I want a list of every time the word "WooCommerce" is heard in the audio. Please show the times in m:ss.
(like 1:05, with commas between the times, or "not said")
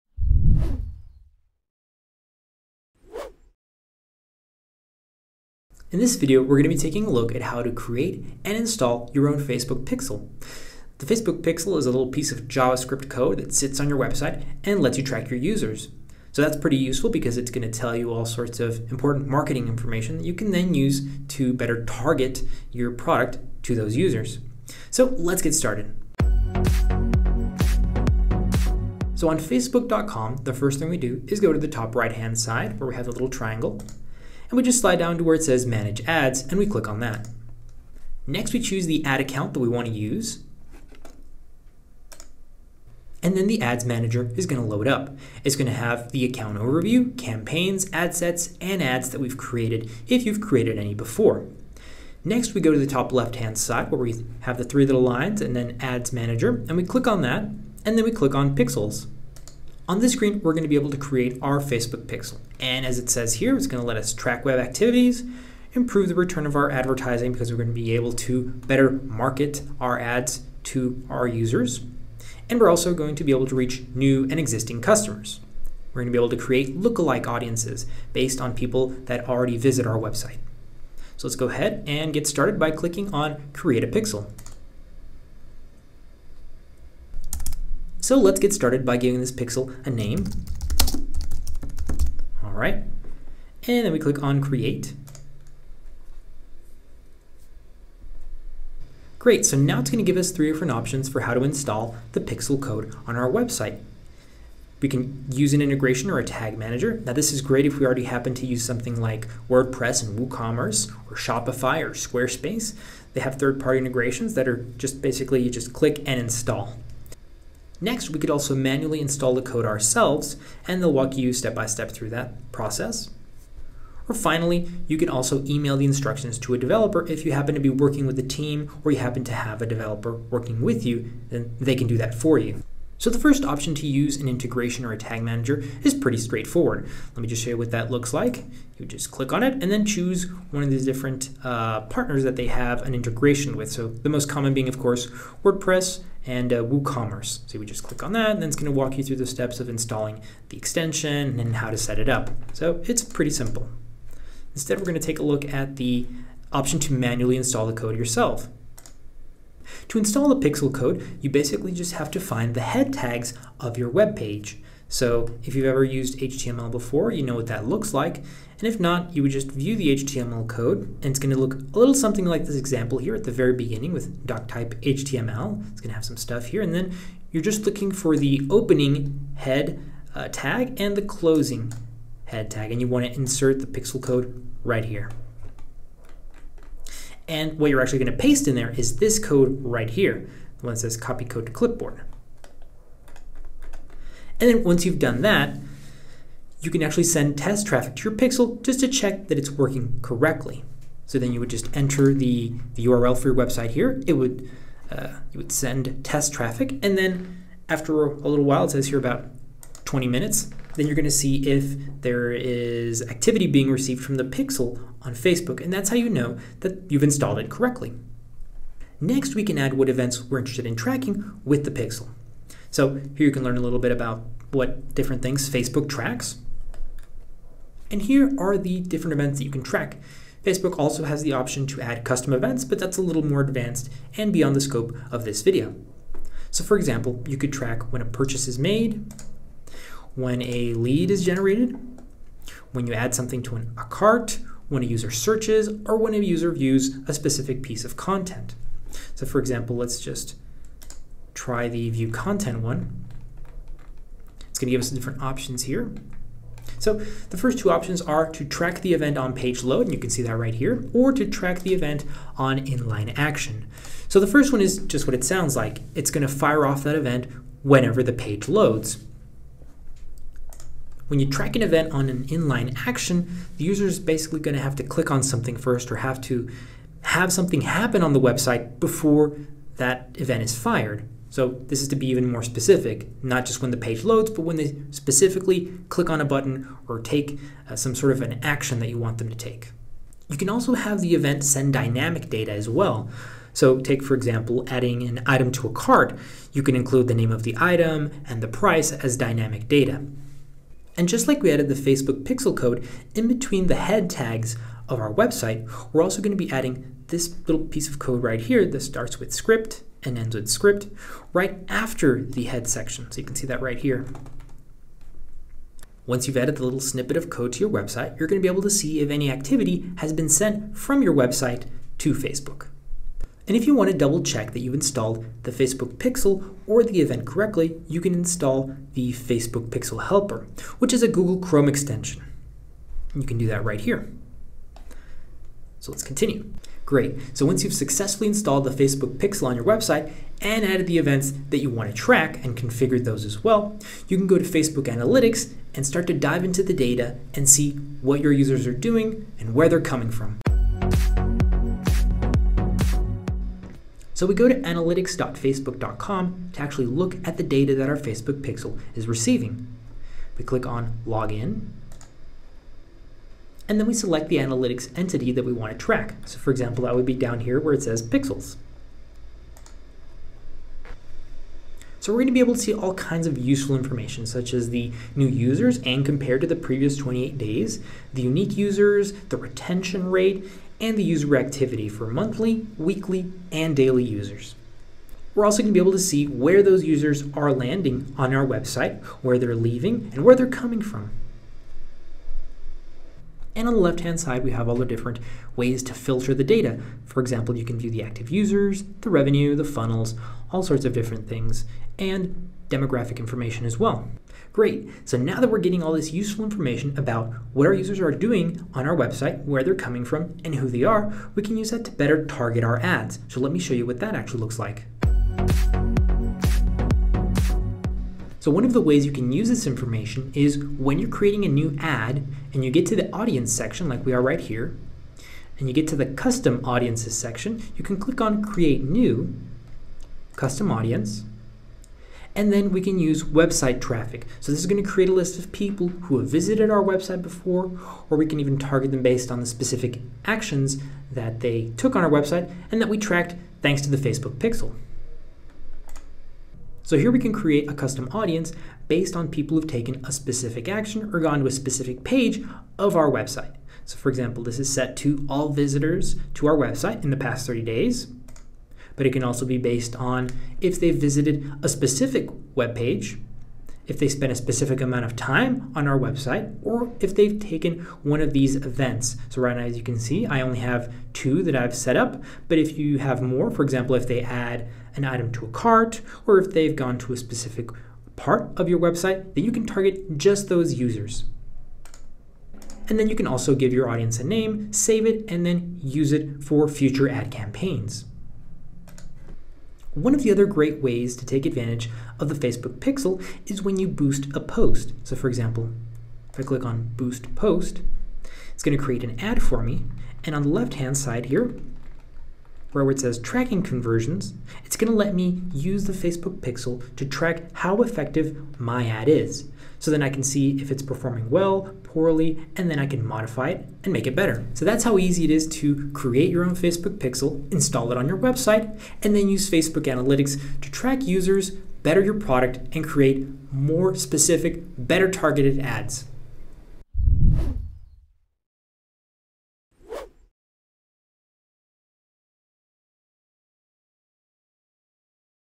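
1:50, 2:26.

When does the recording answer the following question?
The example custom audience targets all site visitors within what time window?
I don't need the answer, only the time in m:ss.
7:37.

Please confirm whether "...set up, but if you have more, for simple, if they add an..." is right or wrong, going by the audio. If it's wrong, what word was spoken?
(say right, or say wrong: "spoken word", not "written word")
wrong: "example", not "simple".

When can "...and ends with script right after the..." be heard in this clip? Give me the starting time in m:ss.
5:10.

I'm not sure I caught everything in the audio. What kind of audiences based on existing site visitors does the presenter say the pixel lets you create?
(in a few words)
lookalike audiences.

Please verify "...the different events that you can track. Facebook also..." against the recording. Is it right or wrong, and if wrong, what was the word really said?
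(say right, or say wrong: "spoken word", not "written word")
right.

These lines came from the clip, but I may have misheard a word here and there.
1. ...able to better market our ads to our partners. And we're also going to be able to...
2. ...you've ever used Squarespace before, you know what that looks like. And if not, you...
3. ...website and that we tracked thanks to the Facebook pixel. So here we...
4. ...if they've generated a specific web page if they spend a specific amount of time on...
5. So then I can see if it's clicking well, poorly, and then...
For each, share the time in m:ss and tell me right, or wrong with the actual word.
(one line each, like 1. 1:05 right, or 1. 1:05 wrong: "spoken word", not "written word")
1. 1:07 wrong: "users", not "partners"
2. 2:45 wrong: "HTML", not "Squarespace"
3. 7:22 right
4. 7:40 wrong: "visited", not "generated"
5. 8:29 wrong: "performing", not "clicking".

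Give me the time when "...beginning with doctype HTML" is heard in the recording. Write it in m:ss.
2:53.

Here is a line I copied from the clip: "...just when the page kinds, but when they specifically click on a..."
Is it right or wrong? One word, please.
wrong.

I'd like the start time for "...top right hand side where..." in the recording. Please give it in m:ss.
0:31.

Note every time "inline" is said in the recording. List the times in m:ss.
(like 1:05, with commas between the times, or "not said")
4:22, 4:32.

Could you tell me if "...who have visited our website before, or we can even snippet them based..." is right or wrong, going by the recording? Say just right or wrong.
wrong.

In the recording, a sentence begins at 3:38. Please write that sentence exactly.
Next, we can add what events we're interested in tracking with the pixel.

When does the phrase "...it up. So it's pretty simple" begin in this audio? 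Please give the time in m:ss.
2:31.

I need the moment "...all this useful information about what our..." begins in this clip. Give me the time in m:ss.
6:45.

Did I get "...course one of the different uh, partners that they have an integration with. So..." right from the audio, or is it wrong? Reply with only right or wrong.
wrong.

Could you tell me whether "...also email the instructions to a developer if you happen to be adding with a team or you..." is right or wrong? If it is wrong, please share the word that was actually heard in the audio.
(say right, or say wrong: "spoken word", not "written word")
wrong: "working", not "adding".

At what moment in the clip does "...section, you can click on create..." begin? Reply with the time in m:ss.
7:07.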